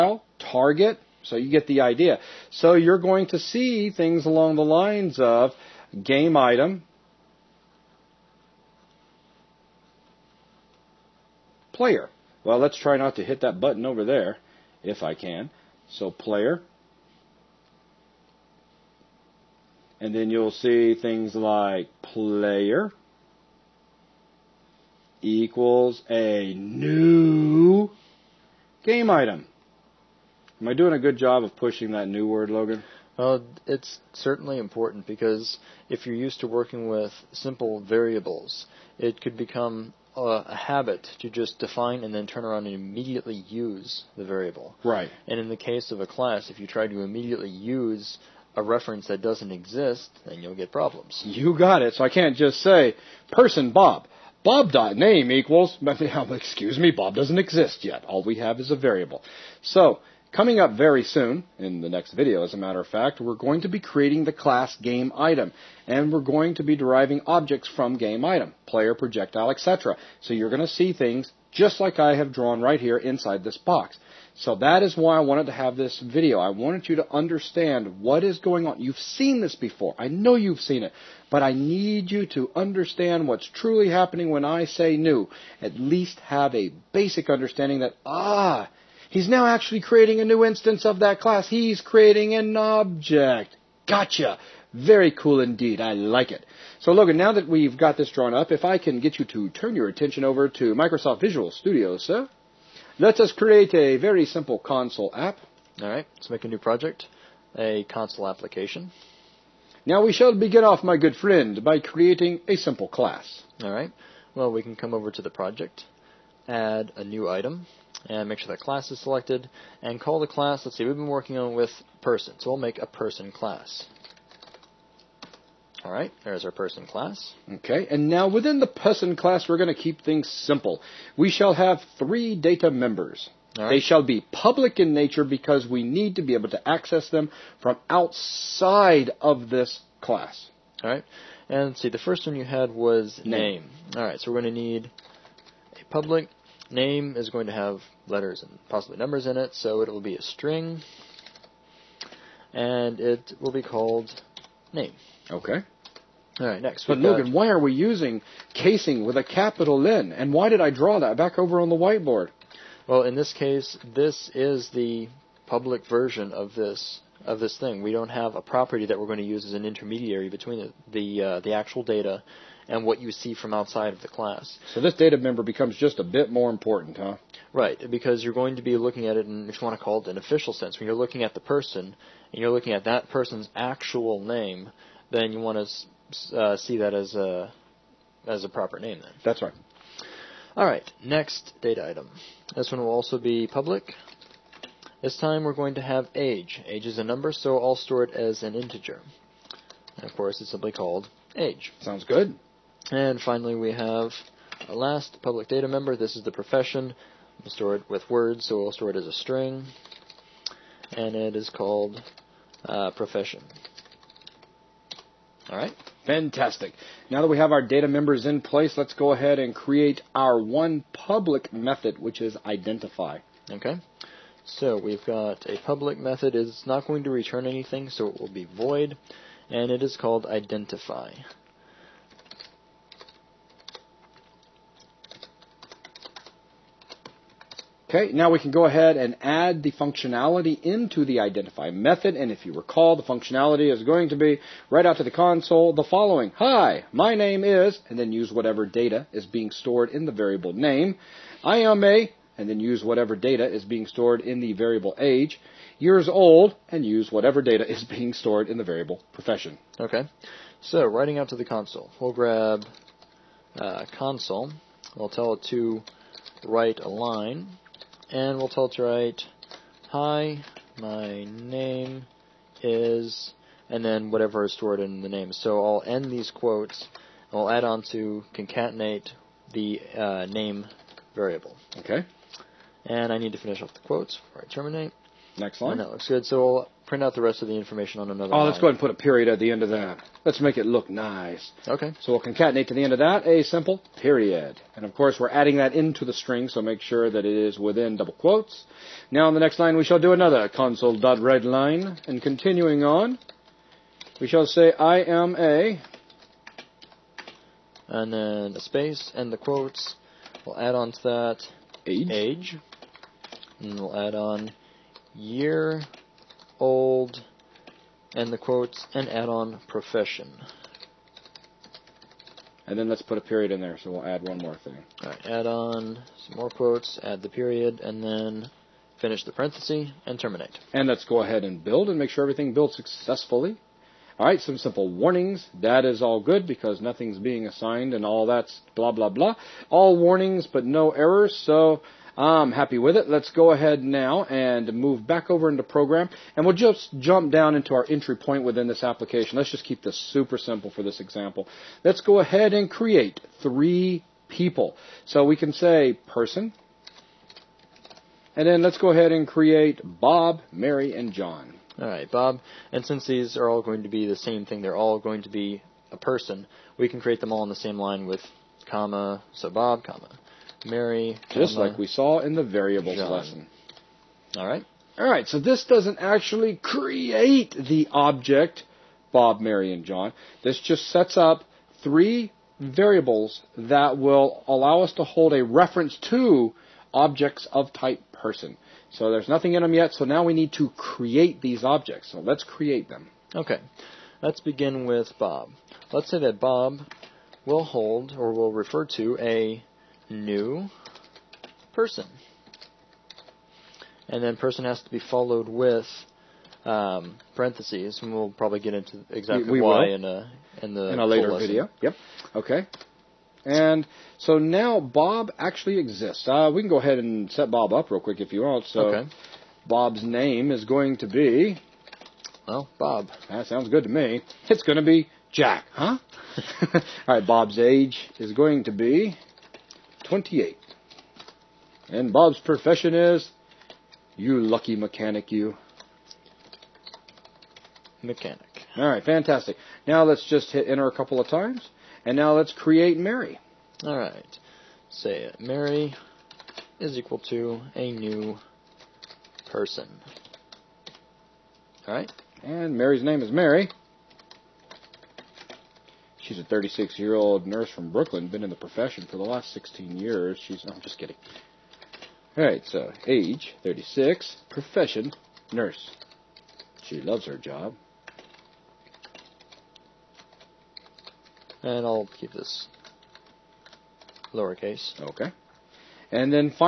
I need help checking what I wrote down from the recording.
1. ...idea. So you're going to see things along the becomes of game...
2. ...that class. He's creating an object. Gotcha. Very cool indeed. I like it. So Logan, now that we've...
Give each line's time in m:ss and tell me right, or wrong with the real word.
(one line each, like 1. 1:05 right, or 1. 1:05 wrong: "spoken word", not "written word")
1. 0:01 wrong: "lines", not "becomes"
2. 1:30 right.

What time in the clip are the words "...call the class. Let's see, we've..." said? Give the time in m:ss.
2:00.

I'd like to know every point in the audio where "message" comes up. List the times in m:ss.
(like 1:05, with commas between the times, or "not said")
not said.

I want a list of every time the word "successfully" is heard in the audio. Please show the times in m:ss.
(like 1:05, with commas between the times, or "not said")
5:32.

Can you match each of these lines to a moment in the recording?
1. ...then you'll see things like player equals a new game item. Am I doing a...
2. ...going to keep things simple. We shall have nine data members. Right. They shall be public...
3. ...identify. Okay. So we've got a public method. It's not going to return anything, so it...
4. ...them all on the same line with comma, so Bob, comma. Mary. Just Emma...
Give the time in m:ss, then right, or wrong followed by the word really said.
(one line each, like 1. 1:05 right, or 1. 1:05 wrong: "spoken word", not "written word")
1. 0:20 right
2. 2:09 wrong: "three", not "nine"
3. 3:42 right
4. 6:07 right.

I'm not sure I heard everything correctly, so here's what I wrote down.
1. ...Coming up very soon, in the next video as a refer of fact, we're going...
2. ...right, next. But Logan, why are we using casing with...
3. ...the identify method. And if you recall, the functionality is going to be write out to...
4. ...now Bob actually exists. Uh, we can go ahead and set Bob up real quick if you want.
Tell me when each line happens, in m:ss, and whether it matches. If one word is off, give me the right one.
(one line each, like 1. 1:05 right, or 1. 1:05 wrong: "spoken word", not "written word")
1. 1:00 wrong: "matter", not "refer"
2. 2:36 right
3. 4:01 right
4. 6:54 right.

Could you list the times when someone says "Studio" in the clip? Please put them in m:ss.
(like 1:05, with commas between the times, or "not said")
1:41.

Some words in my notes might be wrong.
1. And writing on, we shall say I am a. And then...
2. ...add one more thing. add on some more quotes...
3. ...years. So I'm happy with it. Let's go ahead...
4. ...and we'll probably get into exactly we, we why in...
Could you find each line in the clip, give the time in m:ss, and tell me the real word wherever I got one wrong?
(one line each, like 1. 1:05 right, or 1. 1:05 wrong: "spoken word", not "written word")
1. 5:02 wrong: "continuing", not "writing"
2. 5:24 right
3. 5:40 wrong: "errors", not "years"
4. 6:48 right.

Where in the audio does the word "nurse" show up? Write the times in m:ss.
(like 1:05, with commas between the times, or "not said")
7:37, 7:45.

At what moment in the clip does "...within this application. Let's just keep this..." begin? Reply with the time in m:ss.
5:48.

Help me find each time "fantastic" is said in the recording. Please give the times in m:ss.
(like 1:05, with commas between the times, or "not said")
3:36, 7:19.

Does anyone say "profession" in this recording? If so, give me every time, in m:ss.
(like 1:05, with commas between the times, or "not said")
3:26, 3:32, 4:19, 5:19, 7:12, 7:38, 7:44.